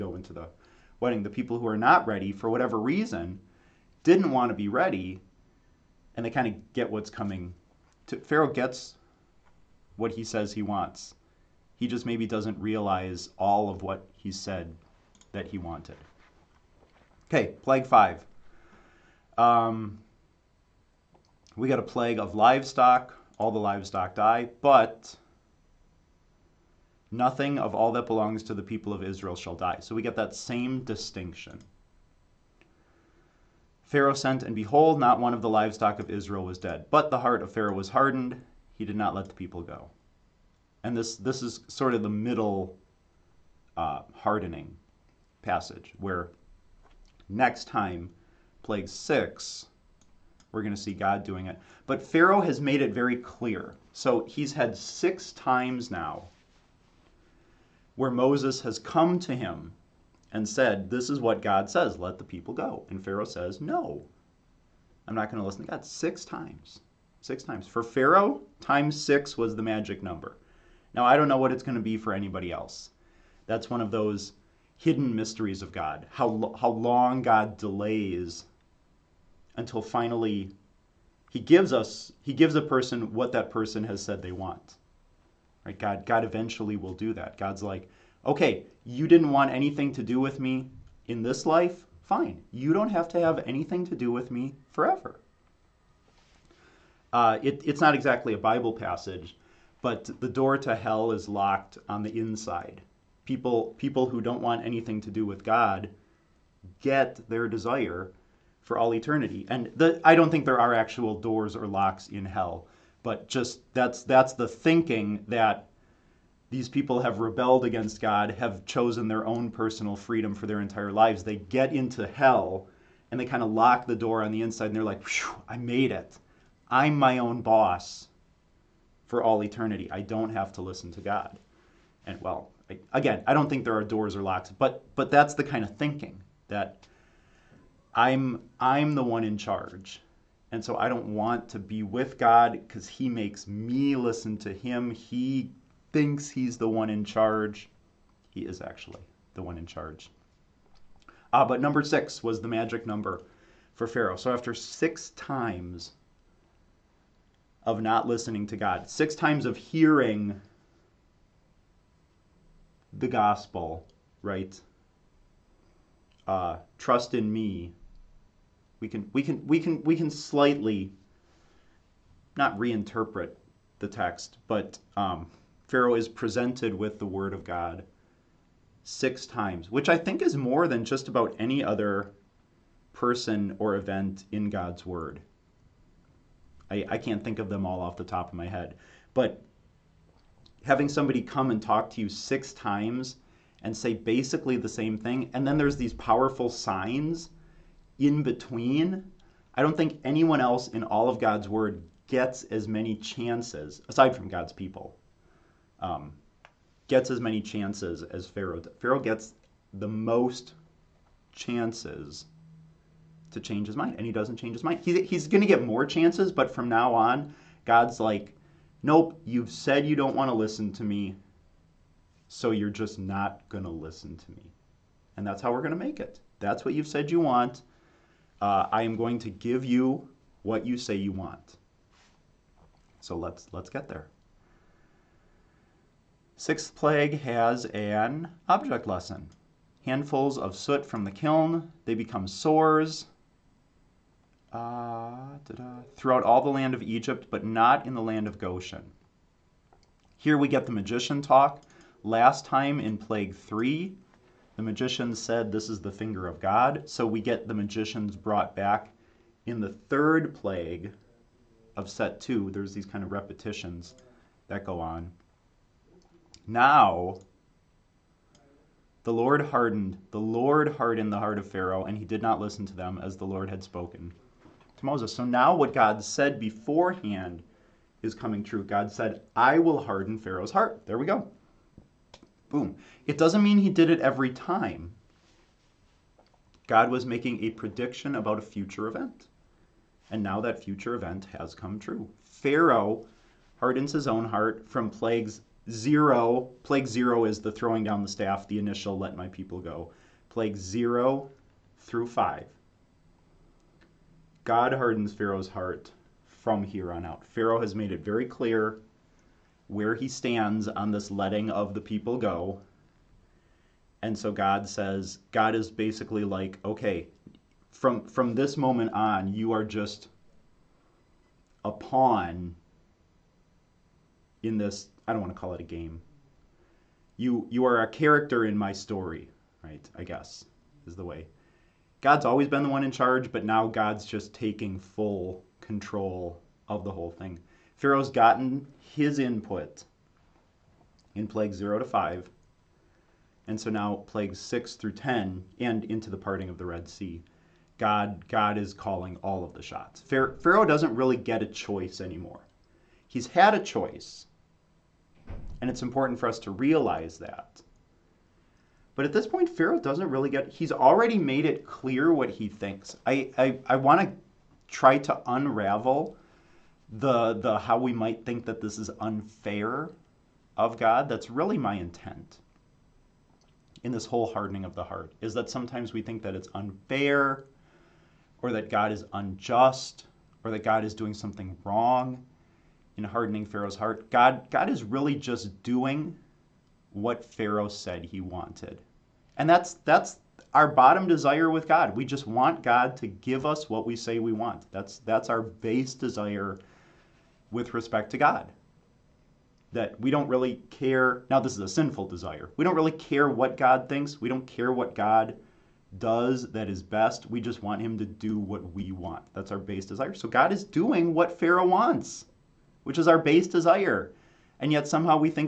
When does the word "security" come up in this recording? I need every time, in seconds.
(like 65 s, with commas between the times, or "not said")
not said.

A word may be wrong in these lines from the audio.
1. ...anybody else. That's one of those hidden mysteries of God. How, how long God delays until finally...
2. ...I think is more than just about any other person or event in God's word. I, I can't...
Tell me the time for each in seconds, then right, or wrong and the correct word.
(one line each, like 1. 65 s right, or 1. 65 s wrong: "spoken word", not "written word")
1. 72 s right
2. 179 s right.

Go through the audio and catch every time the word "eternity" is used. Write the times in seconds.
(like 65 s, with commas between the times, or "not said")
108 s, 129 s.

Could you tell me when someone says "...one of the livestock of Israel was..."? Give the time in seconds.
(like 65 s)
35 s.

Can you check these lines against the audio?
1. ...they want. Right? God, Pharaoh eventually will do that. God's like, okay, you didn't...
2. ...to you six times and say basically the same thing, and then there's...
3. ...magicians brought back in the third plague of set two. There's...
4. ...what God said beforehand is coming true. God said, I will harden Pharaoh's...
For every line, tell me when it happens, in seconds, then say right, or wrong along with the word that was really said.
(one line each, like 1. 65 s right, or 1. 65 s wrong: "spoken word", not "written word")
1. 84 s wrong: "God", not "Pharaoh"
2. 191 s right
3. 257 s right
4. 275 s right.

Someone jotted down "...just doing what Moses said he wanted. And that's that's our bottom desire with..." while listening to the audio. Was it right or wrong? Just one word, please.
wrong.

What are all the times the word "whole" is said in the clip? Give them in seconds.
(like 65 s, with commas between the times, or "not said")
336 s, 374 s.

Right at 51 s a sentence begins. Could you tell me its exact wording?
But Pharaoh has made it very clear.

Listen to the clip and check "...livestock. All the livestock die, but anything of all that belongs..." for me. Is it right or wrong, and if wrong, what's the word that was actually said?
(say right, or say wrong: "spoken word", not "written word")
wrong: "nothing", not "anything".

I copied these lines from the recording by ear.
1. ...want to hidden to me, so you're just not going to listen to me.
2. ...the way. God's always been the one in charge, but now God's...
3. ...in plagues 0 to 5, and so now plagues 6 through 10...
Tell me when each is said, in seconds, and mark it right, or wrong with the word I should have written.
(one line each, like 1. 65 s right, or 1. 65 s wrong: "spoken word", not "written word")
1. 220 s wrong: "listen", not "hidden"
2. 330 s right
3. 341 s right.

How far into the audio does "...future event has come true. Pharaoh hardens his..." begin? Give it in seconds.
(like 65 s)
290 s.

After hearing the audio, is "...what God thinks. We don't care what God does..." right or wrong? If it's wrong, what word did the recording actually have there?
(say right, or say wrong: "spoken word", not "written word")
right.